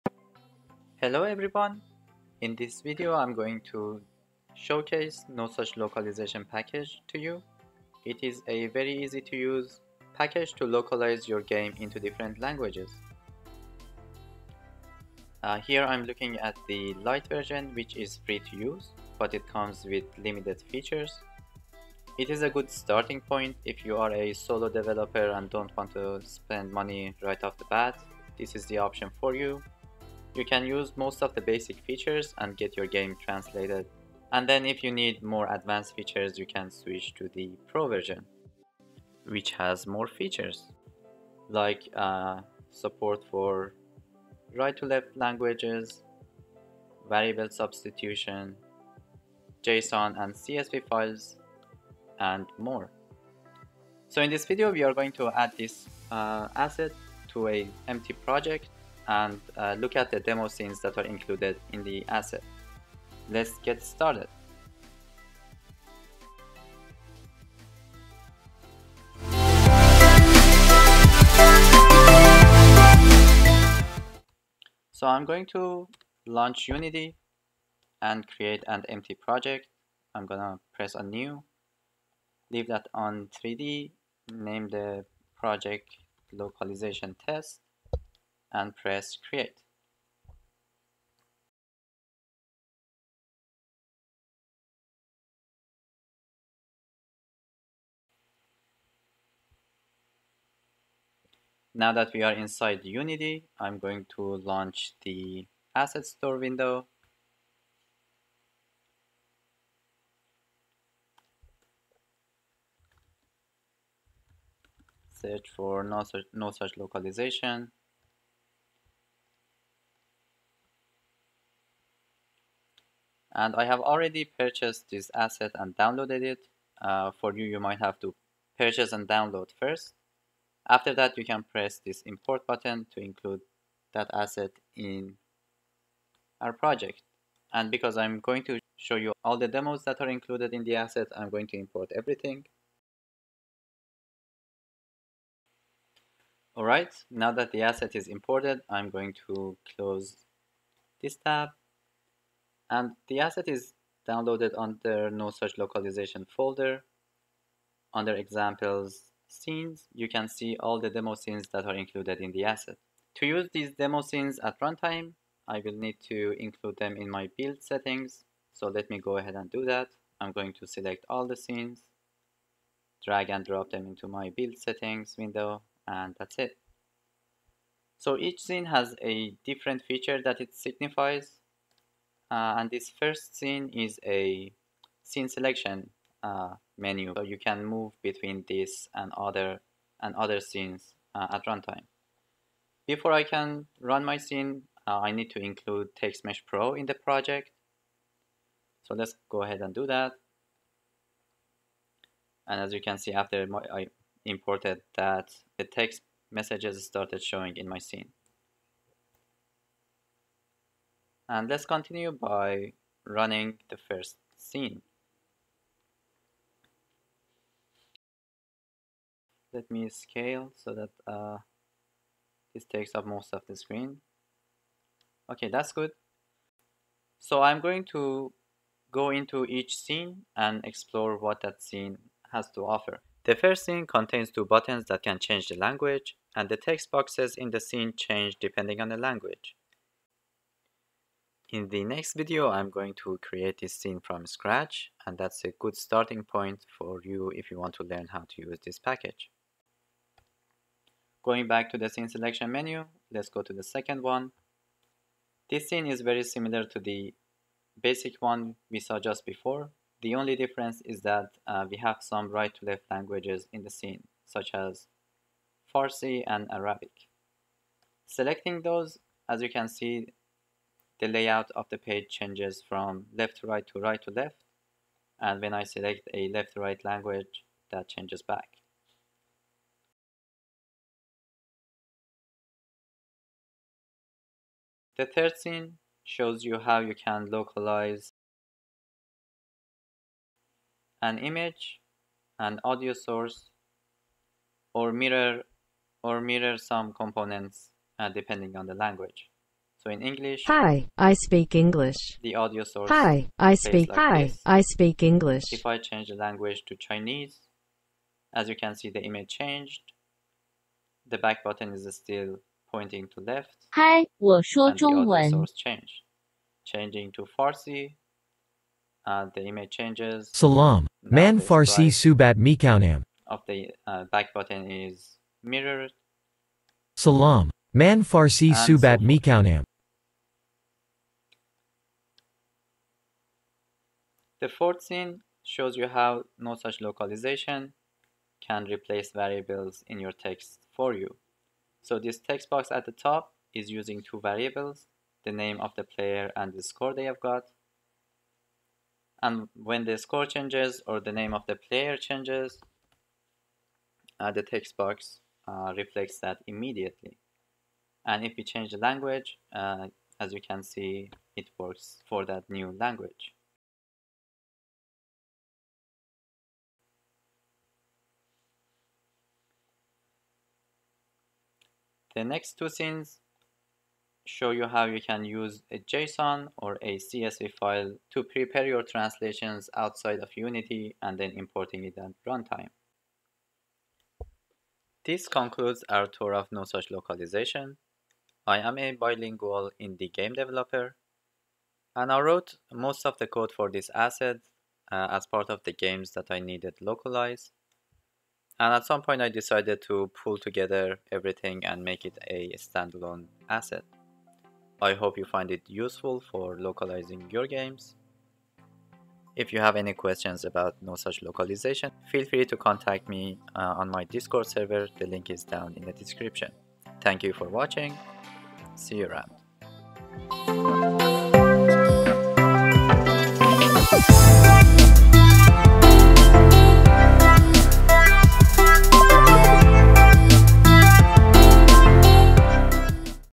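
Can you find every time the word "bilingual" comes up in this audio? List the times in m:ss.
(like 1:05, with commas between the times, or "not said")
6:28.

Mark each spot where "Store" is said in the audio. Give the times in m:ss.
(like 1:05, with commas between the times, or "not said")
1:46.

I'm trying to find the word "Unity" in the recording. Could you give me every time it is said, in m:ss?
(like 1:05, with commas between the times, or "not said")
1:16, 1:42, 6:20.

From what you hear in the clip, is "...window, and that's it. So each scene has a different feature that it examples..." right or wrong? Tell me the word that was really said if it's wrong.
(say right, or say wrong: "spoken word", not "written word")
wrong: "signifies", not "examples".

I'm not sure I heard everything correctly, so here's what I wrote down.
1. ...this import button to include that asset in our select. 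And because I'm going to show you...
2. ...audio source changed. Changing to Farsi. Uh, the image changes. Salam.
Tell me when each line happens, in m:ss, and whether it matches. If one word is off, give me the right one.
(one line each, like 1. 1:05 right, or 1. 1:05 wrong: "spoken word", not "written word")
1. 2:11 wrong: "project", not "select"
2. 5:15 right.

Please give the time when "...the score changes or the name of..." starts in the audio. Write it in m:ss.
5:49.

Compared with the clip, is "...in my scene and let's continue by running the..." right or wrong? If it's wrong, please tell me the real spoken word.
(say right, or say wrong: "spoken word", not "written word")
right.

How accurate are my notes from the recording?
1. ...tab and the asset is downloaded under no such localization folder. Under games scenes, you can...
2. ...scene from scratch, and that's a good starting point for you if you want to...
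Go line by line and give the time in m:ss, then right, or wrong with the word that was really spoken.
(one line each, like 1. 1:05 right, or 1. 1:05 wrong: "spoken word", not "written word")
1. 2:31 wrong: "examples", not "games"
2. 4:03 right.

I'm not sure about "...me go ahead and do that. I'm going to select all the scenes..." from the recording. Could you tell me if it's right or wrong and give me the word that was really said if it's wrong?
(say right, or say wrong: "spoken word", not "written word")
right.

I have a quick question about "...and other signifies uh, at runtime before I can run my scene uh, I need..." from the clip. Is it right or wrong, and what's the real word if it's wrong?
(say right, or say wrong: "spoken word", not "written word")
wrong: "scenes", not "signifies".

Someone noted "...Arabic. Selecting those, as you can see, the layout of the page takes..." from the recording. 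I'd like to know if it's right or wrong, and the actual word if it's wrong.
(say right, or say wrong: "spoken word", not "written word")
wrong: "changes", not "takes".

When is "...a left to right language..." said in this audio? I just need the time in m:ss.
4:36.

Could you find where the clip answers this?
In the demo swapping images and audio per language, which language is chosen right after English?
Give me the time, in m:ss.
5:06.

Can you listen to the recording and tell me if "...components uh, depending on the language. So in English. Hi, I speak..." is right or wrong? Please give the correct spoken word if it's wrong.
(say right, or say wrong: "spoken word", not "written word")
right.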